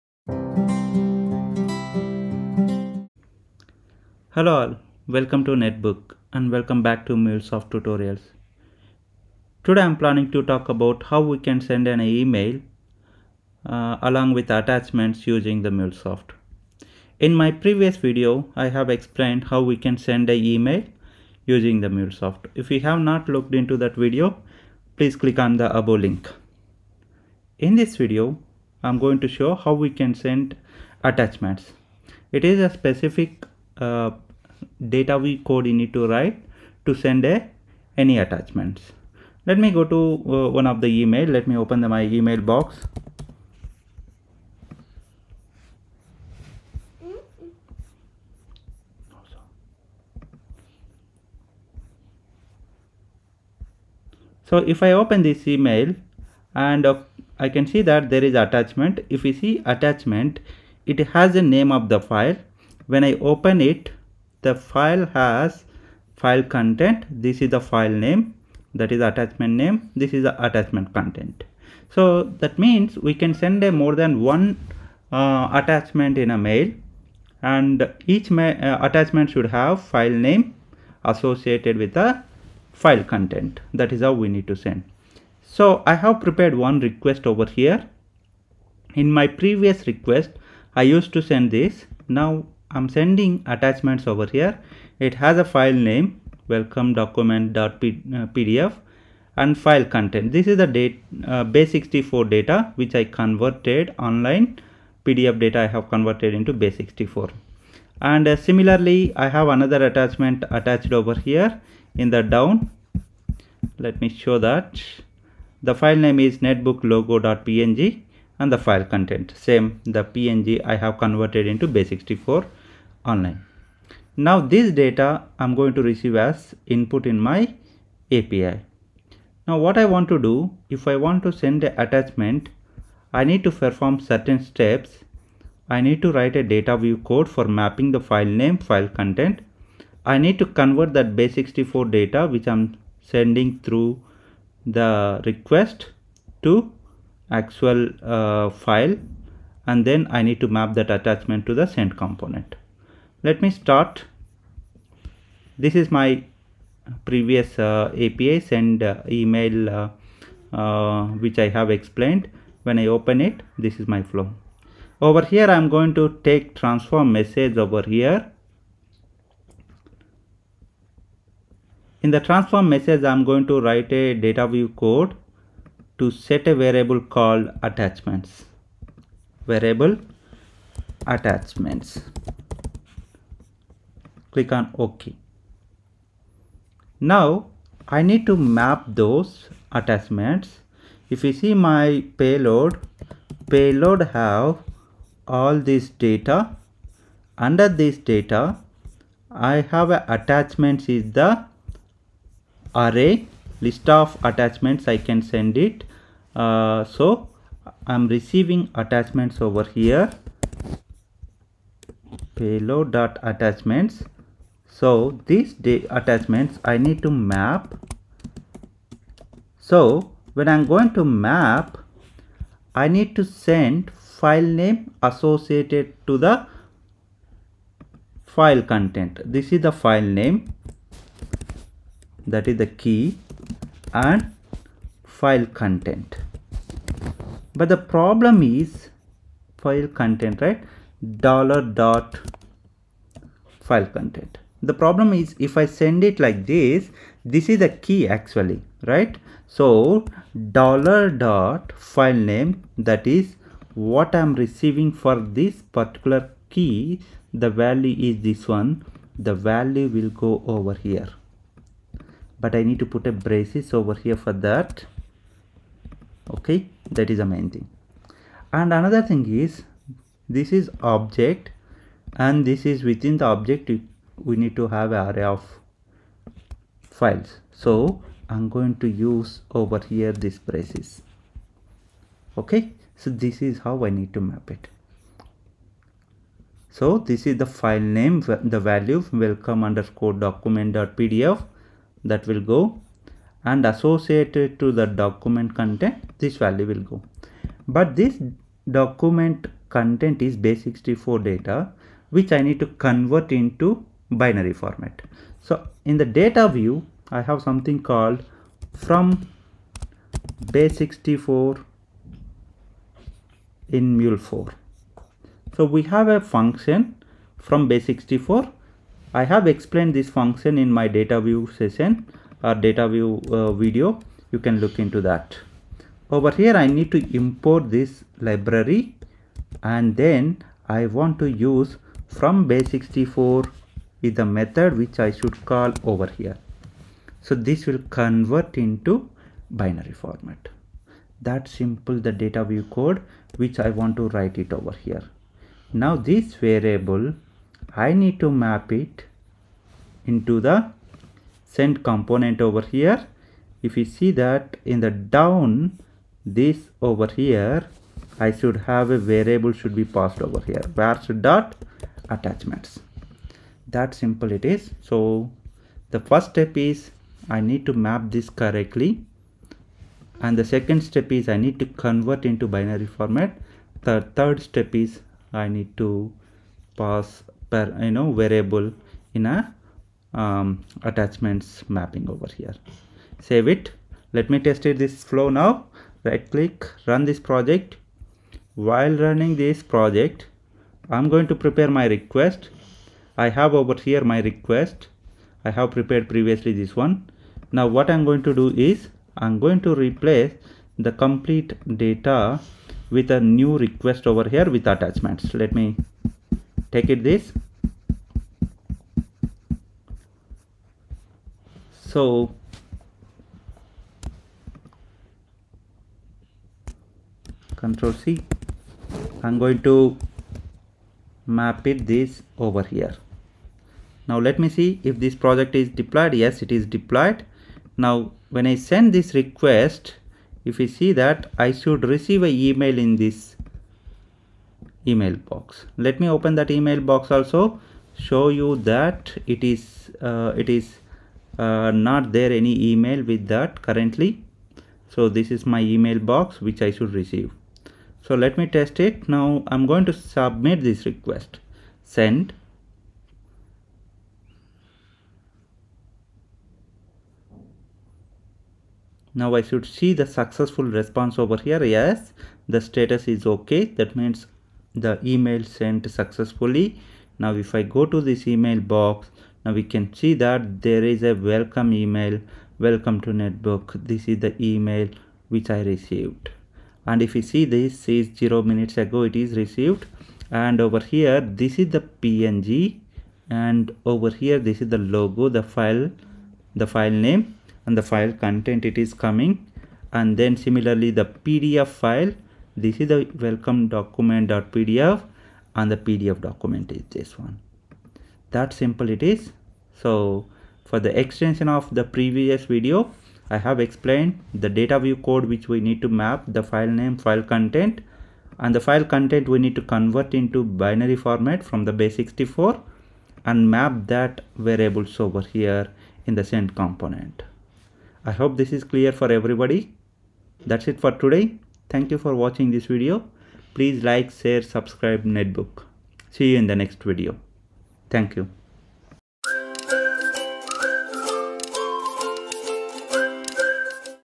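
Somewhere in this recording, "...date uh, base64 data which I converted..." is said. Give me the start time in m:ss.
1:40.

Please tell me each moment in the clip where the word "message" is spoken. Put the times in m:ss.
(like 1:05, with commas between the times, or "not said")
2:47, 2:52.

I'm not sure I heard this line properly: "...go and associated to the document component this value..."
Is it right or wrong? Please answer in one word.
wrong.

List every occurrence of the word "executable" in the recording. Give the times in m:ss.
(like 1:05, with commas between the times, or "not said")
not said.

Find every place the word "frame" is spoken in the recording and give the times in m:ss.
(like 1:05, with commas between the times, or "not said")
not said.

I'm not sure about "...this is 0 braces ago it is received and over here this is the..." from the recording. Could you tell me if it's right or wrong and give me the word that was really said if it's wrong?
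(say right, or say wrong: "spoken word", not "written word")
wrong: "minutes", not "braces".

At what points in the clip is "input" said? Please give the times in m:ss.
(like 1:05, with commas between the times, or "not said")
2:06.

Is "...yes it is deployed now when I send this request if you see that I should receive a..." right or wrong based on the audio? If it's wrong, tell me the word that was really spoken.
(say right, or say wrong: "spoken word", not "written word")
right.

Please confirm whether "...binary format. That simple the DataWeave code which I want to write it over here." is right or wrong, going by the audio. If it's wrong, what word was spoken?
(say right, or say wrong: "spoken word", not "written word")
right.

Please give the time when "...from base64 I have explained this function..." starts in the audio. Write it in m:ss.
5:17.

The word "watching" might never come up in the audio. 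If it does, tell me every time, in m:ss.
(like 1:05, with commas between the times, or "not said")
8:42.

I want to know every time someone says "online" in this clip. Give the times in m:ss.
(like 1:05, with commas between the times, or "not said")
1:43, 2:03.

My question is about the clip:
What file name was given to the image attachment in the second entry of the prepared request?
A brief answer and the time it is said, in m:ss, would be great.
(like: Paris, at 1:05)
netbooklogo.png, at 1:56.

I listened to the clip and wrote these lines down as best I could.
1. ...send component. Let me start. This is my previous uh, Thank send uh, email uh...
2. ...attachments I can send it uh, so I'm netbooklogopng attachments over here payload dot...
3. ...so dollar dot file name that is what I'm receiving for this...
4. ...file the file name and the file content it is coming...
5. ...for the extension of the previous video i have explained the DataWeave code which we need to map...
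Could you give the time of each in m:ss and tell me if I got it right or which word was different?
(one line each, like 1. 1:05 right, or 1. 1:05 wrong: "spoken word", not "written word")
1. 2:31 wrong: "API", not "Thank"
2. 3:24 wrong: "receiving", not "netbooklogopng"
3. 4:09 right
4. 8:05 right
5. 8:20 right.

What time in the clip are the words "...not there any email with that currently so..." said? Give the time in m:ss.
7:21.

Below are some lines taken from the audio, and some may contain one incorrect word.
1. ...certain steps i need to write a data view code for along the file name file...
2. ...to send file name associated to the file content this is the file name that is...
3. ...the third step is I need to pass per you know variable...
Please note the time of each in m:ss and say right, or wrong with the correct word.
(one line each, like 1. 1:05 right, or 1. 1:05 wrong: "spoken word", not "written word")
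1. 2:13 wrong: "mapping", not "along"
2. 3:43 right
3. 6:13 right.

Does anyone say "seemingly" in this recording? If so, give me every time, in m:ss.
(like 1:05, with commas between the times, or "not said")
not said.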